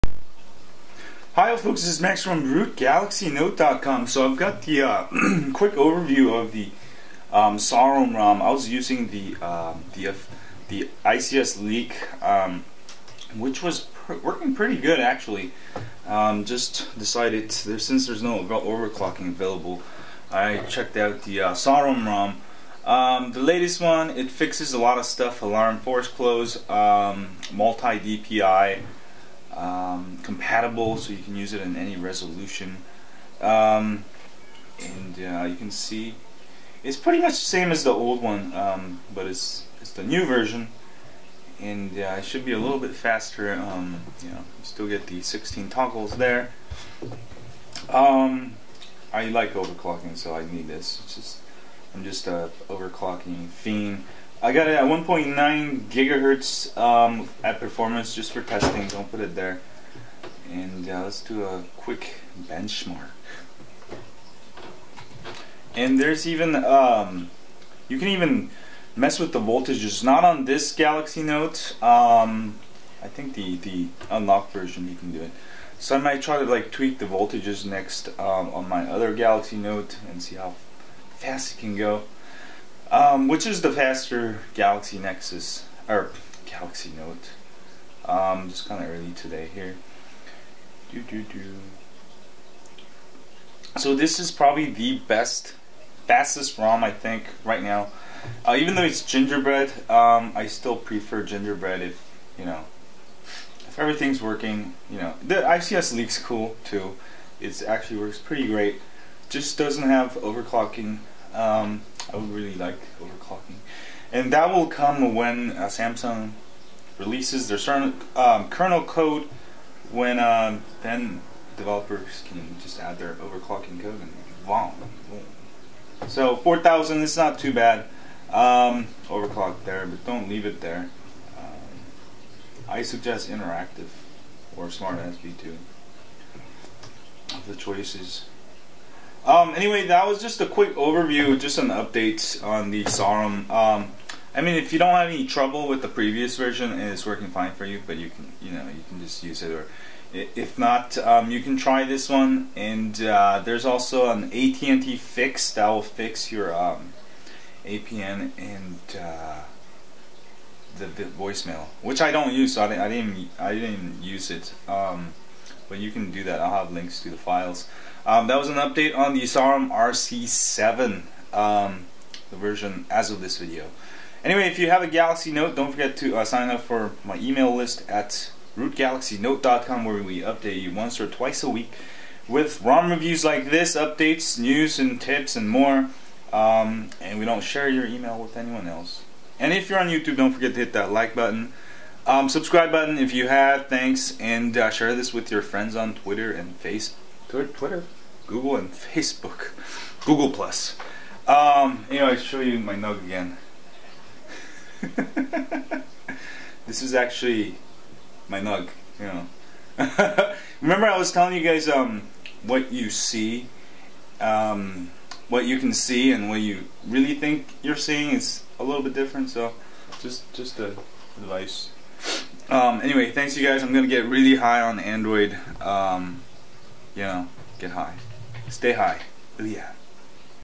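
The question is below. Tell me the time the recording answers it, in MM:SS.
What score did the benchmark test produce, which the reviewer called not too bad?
02:06.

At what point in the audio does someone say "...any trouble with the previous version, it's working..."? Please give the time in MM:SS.
02:25.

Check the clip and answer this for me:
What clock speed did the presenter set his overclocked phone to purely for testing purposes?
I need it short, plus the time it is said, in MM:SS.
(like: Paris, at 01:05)
1.9 gigahertz, at 00:54.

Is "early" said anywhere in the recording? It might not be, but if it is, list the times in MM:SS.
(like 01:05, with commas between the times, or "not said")
01:28.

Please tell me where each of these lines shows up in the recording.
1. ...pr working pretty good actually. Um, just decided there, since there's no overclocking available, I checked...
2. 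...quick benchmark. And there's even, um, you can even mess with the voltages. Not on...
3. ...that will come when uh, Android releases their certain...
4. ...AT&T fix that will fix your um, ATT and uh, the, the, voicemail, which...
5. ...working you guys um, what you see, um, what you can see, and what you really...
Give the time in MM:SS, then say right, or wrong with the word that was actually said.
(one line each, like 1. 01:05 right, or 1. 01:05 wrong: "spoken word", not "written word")
1. 00:13 right
2. 01:01 right
3. 01:54 wrong: "Samsung", not "Android"
4. 02:34 wrong: "APN", not "ATT"
5. 03:31 wrong: "telling", not "working".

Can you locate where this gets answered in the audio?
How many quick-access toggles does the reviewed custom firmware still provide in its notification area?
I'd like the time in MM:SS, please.
00:45.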